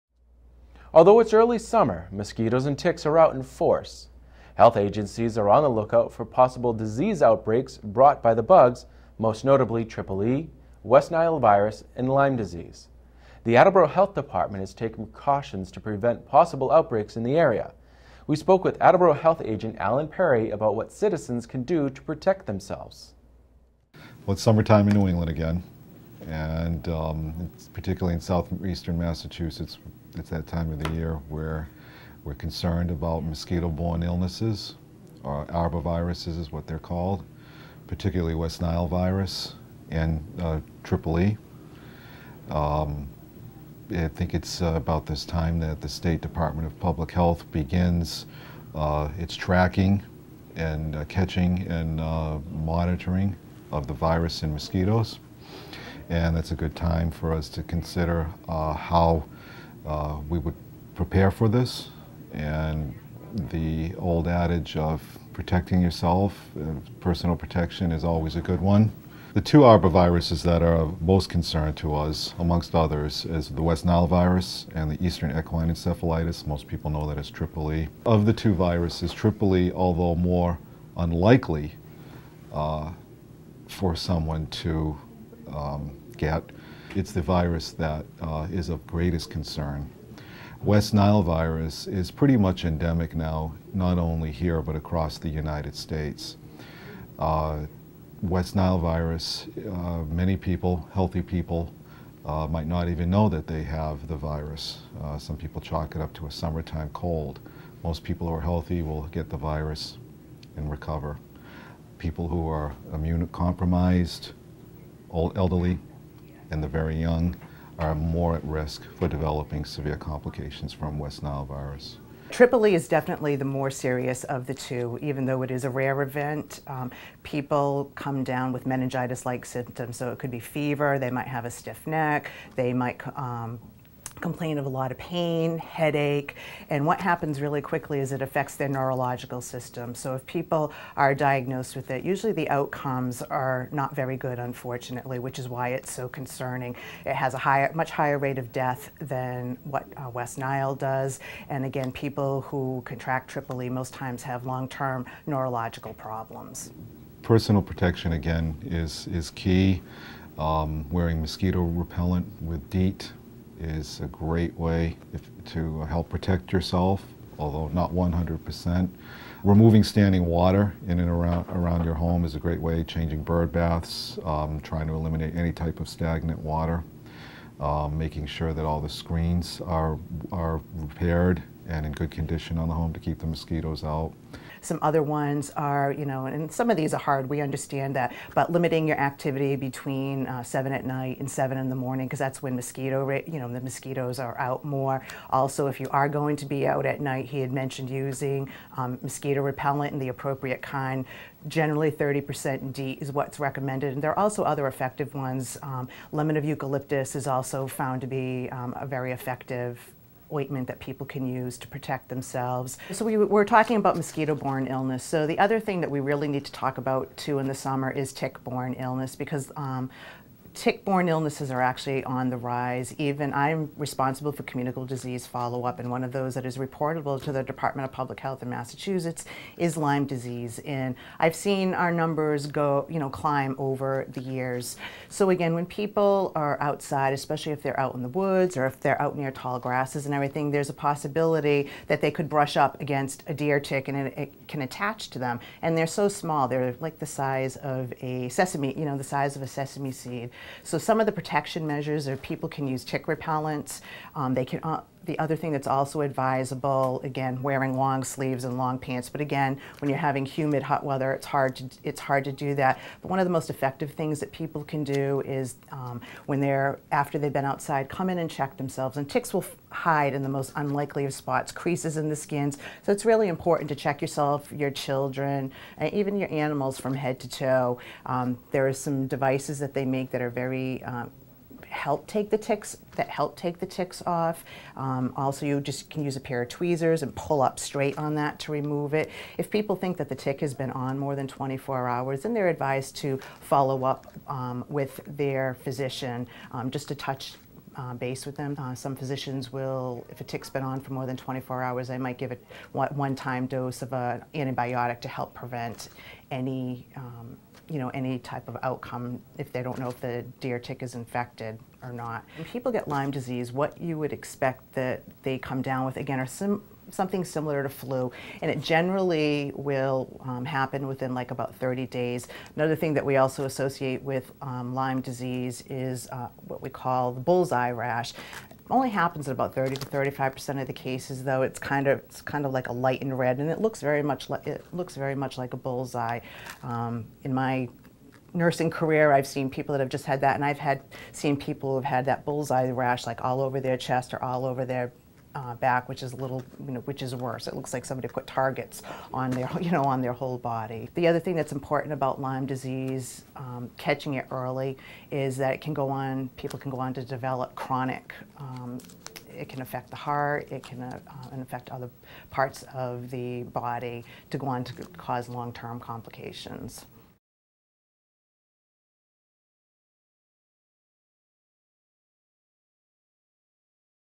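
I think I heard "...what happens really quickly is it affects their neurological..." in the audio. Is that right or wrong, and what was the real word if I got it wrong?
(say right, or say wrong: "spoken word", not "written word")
right.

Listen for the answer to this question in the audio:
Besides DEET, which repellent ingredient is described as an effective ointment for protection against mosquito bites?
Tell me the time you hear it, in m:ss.
3:26.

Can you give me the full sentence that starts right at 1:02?
And the old adage of protecting yourself, uh, personal protection is always a good one.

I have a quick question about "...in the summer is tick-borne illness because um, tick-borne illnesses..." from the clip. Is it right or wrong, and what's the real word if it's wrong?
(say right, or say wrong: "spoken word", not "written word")
right.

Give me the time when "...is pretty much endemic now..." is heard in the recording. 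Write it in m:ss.
1:31.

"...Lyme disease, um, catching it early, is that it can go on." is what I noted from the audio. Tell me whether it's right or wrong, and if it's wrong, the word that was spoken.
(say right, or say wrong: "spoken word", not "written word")
right.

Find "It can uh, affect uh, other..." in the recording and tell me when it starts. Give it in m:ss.
6:00.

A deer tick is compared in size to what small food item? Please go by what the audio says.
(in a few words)
a sesame seed.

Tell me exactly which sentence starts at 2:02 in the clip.
Triple E is definitely the more serious of the two, even though it is a rare event.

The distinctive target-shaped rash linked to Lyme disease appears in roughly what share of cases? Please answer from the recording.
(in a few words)
30 to 35 percent.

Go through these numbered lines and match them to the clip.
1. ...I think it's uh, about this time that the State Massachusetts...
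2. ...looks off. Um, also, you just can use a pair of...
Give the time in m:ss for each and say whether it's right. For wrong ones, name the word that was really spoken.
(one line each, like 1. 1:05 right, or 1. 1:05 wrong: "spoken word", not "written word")
1. 0:43 wrong: "Department", not "Massachusetts"
2. 4:43 wrong: "ticks", not "looks".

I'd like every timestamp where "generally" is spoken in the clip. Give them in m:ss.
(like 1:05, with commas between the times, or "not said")
3:21, 5:18.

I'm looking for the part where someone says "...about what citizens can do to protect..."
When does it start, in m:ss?
0:20.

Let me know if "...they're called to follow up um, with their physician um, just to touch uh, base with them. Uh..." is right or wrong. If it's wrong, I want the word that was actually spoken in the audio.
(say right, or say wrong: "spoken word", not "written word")
wrong: "advised", not "called".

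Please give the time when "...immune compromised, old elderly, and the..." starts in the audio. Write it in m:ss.
1:52.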